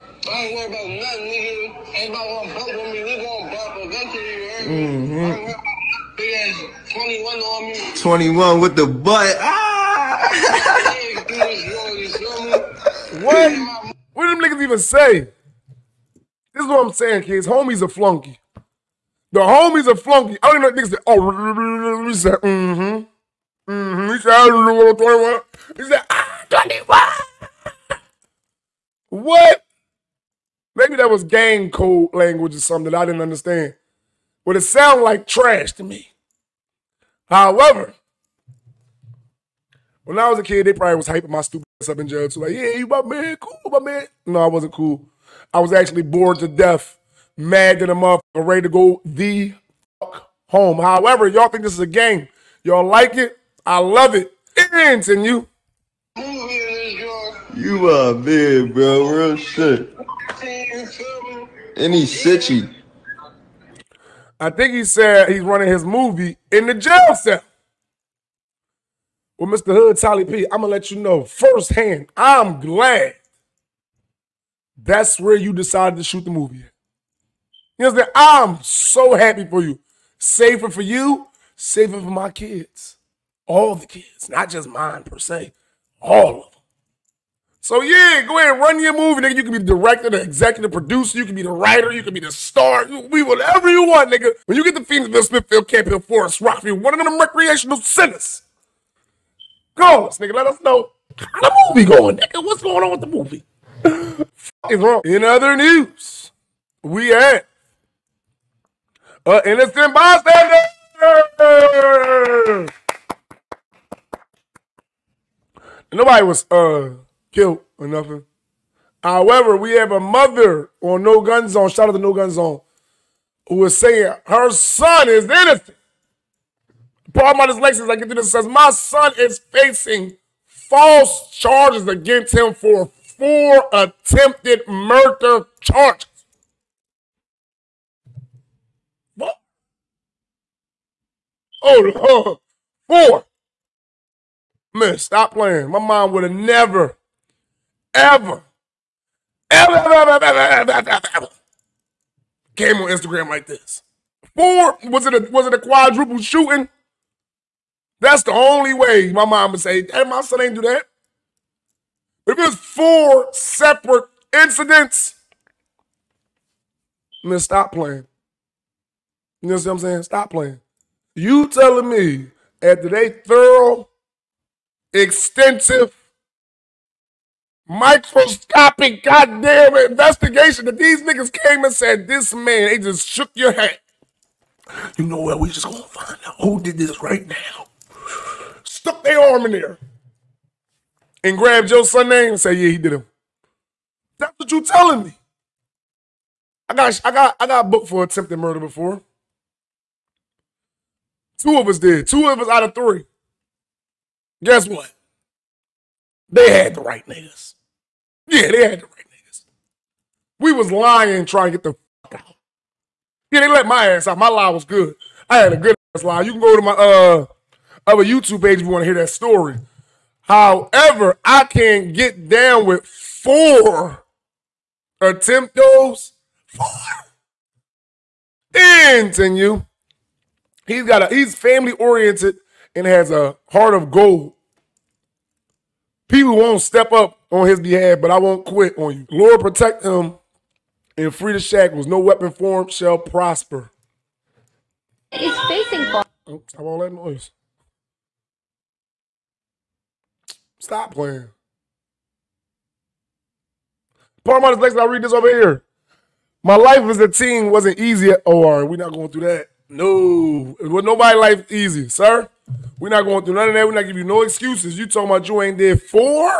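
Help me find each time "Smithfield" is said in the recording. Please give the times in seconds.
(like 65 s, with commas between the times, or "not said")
95 s.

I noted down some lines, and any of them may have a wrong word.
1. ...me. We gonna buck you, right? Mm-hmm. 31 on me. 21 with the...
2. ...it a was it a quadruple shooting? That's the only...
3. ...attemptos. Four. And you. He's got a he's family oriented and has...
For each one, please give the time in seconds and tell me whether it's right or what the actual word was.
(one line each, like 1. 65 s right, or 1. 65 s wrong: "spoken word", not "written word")
1. 2 s wrong: "21", not "31"
2. 155 s right
3. 225 s right.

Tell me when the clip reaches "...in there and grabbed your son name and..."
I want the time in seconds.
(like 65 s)
189 s.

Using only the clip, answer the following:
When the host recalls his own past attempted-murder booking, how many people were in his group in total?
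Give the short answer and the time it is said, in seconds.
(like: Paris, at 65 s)
3, at 202 s.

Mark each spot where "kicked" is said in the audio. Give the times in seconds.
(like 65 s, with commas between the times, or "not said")
not said.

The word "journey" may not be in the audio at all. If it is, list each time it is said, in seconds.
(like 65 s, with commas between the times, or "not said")
not said.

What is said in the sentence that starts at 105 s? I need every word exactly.
In other news, we at an innocent bystander.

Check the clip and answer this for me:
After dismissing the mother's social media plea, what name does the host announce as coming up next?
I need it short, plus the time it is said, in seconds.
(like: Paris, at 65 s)
Paramount, at 254 s.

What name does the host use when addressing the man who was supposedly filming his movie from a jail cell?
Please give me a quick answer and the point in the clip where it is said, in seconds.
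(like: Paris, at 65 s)
Tali P, at 69 s.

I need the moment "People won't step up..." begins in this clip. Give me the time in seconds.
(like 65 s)
236 s.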